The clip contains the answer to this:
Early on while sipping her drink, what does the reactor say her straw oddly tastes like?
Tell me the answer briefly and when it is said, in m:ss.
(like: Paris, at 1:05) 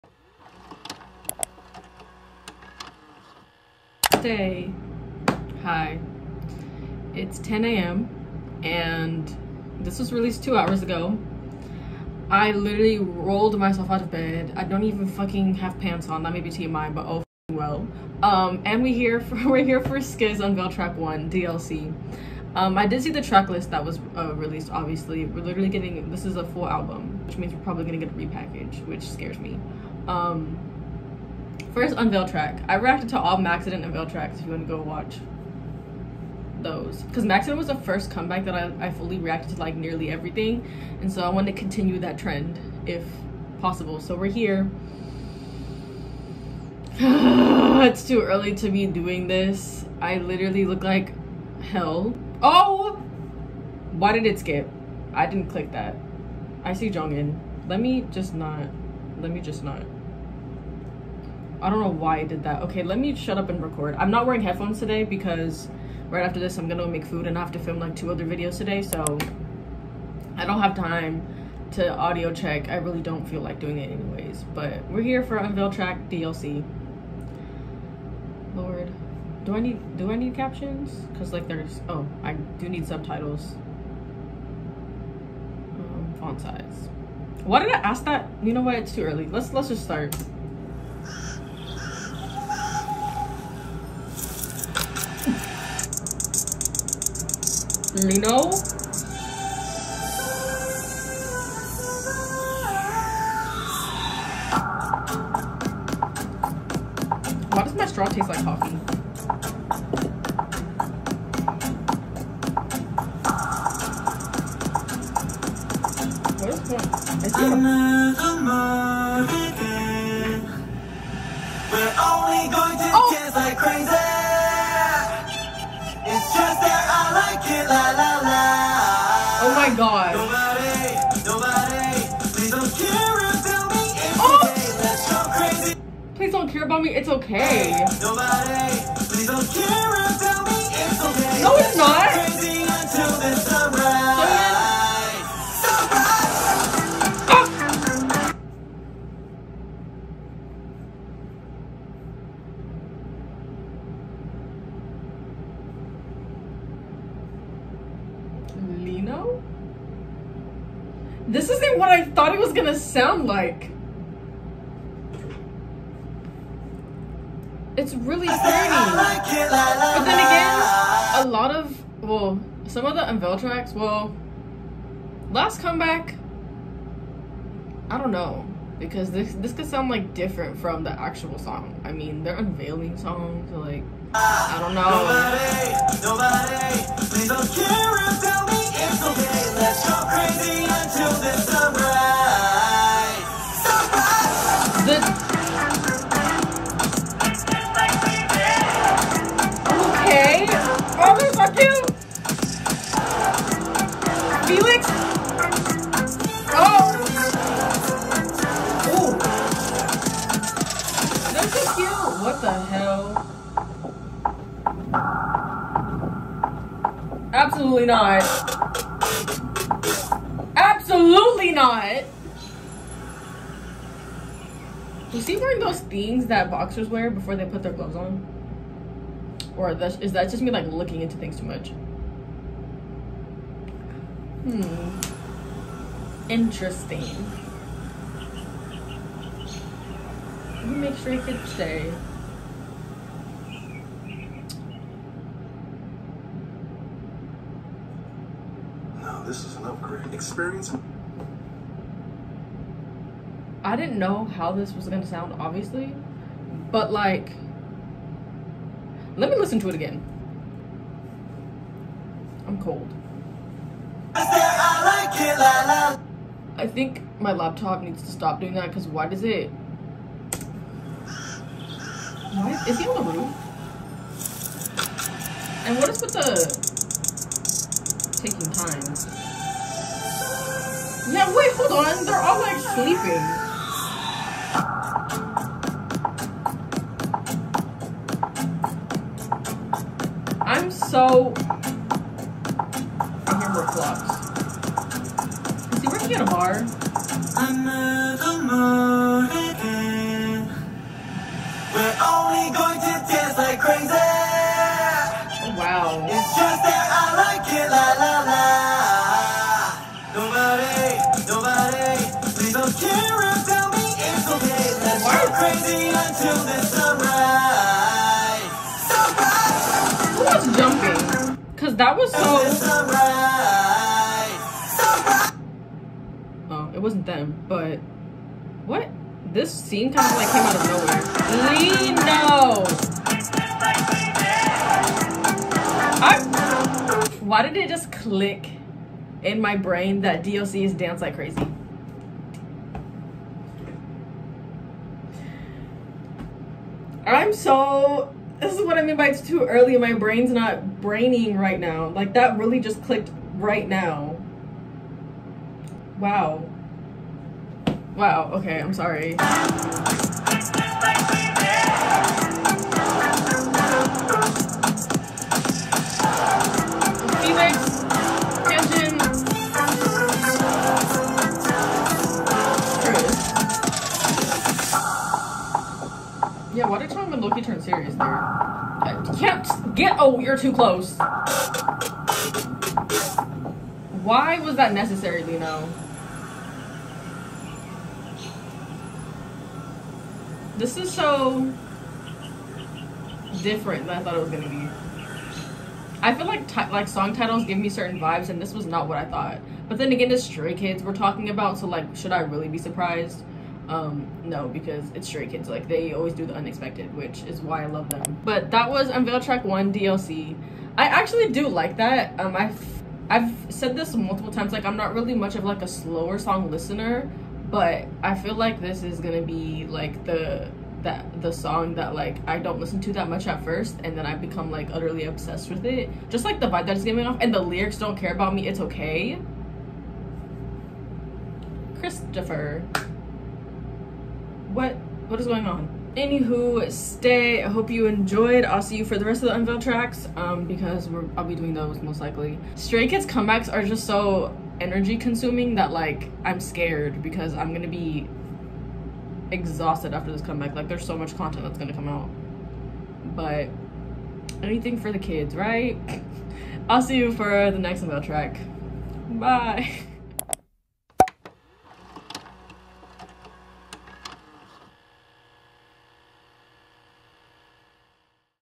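Coffee, at 1:48.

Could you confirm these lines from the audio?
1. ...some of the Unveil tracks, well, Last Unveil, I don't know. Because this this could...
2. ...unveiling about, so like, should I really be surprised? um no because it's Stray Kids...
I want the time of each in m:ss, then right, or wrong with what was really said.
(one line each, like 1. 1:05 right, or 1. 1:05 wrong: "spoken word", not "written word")
1. 2:52 wrong: "Comeback", not "Unveil"
2. 6:40 wrong: "talking", not "unveiling".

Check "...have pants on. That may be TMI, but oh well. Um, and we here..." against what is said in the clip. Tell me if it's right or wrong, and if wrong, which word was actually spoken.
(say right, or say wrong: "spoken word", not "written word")
right.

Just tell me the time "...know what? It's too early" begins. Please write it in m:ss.
1:28.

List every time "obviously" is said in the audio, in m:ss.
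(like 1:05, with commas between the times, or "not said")
0:24, 4:15.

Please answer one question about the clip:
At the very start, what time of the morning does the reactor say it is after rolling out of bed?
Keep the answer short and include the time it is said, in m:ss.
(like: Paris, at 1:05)
10 a.m., at 0:07.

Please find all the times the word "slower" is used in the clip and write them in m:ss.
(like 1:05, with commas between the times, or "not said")
6:55.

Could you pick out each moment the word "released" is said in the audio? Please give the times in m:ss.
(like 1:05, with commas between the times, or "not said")
0:10, 0:24.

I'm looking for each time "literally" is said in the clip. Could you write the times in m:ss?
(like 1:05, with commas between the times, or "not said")
0:12, 0:25, 0:50.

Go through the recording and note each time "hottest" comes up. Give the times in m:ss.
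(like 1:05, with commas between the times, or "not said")
not said.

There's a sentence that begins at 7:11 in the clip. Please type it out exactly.
Christopher what what is going on?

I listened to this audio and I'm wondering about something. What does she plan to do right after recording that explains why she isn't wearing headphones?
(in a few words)
Make food.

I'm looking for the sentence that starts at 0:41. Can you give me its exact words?
And so I want to continue that trend if possible.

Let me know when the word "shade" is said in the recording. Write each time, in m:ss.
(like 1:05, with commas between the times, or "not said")
not said.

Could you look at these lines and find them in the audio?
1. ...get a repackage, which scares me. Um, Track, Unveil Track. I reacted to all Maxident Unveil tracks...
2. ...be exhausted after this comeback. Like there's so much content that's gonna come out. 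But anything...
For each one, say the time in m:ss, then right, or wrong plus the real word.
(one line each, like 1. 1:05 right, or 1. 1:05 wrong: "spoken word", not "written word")
1. 0:27 wrong: "First", not "Track"
2. 7:27 right.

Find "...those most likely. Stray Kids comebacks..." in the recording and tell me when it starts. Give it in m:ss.
7:21.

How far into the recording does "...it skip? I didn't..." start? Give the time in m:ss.
0:54.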